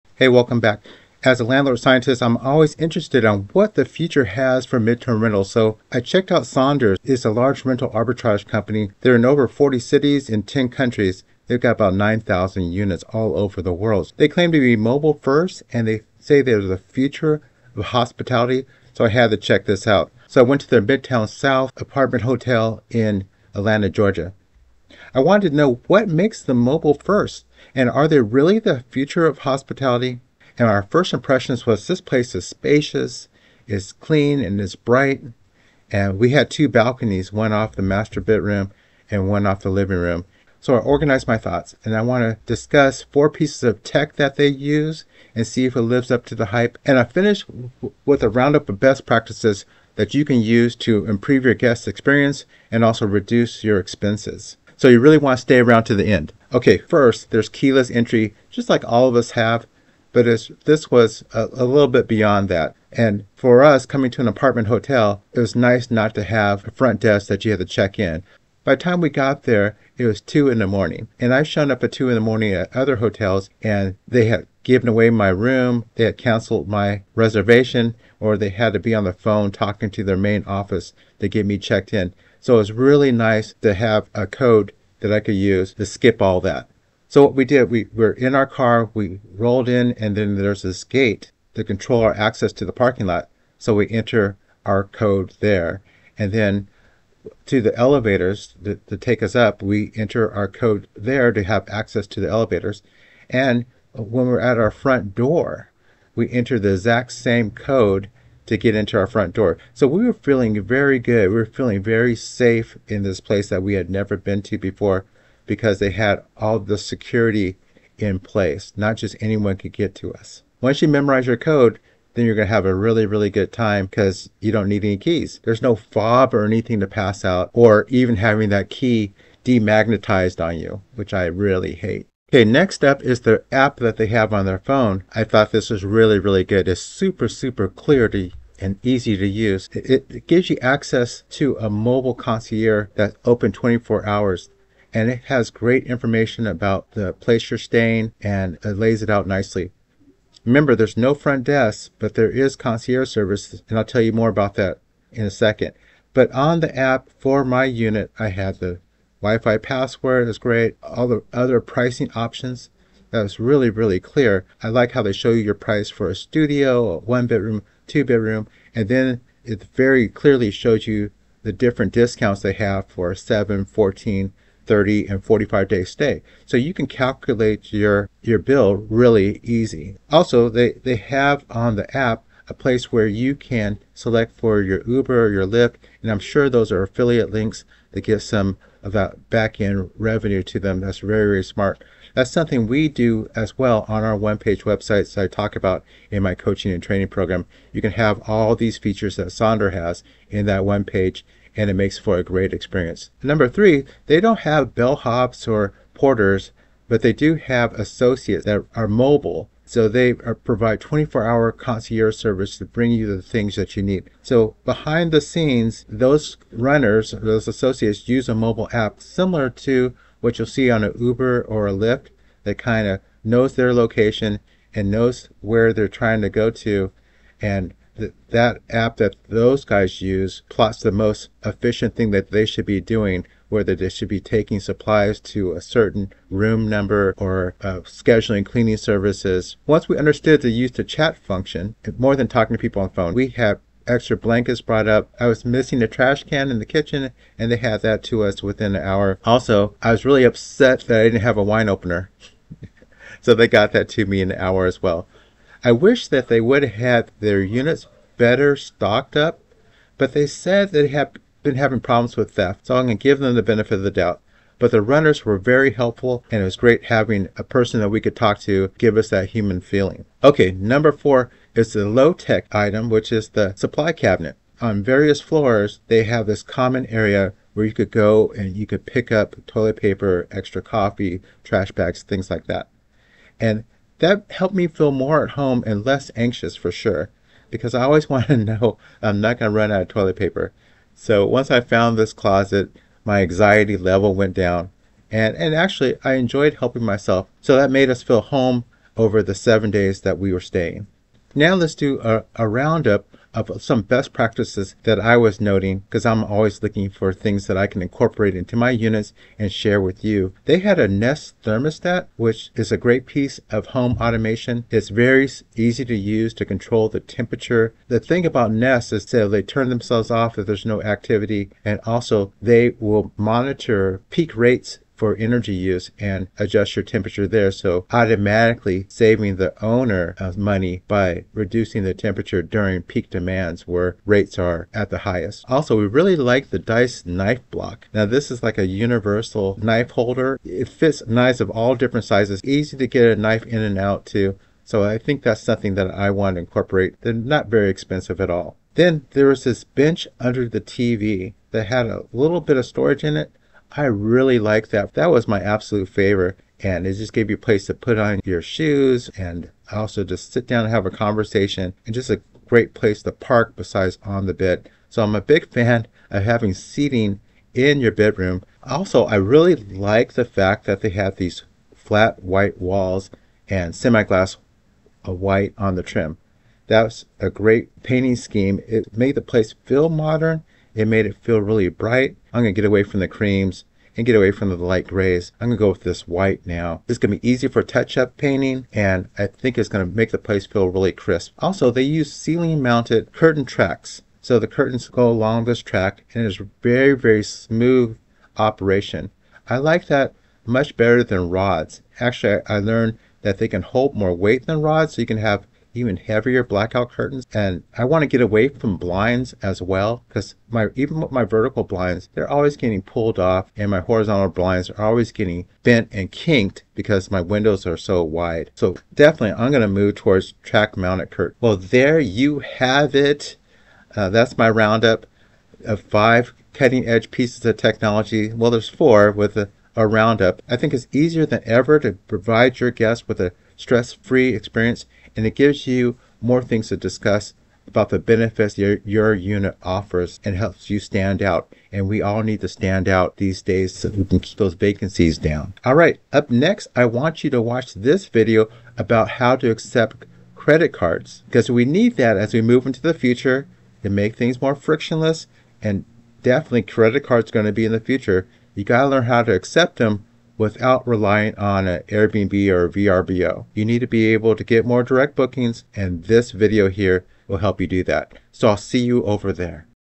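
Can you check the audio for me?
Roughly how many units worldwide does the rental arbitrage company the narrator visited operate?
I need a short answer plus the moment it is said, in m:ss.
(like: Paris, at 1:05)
9,000, at 0:11.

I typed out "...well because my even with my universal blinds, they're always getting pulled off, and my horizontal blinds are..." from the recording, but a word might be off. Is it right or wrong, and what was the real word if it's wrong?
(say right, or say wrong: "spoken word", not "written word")
wrong: "vertical", not "universal".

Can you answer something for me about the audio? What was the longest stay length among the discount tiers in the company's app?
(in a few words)
45 days.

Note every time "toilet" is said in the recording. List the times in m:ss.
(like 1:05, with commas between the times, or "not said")
4:39, 4:49.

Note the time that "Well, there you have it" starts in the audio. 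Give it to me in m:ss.
7:01.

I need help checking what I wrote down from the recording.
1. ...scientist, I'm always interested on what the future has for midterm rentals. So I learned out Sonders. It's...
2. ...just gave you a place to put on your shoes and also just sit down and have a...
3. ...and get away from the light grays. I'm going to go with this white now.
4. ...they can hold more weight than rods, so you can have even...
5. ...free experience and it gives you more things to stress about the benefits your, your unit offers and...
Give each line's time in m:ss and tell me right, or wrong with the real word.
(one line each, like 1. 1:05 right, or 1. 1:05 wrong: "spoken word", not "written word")
1. 0:01 wrong: "checked", not "learned"
2. 5:56 right
3. 6:23 right
4. 6:43 right
5. 7:13 wrong: "discuss", not "stress".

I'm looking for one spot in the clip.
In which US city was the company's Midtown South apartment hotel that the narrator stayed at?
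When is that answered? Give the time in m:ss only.
0:23.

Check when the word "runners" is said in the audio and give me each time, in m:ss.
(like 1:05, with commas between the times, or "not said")
3:36, 4:24.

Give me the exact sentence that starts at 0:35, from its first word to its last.
And we had two balconies, one off the master bedroom and one off the living room.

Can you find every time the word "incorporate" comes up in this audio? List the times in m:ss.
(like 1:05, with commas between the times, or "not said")
5:07, 5:46.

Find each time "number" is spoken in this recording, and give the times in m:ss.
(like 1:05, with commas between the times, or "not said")
3:23, 3:56, 4:30.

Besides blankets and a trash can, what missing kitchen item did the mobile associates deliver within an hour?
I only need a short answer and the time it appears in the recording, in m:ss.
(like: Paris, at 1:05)
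Wine opener, at 4:11.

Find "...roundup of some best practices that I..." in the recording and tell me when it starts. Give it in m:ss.
5:02.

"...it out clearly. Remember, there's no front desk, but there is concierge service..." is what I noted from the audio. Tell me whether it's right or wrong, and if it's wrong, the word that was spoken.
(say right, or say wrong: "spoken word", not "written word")
wrong: "nicely", not "clearly".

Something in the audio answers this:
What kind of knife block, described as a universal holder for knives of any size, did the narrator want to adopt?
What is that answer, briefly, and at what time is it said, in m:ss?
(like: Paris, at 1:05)
Dice knife block, at 5:36.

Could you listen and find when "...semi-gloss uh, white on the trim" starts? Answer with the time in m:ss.
6:13.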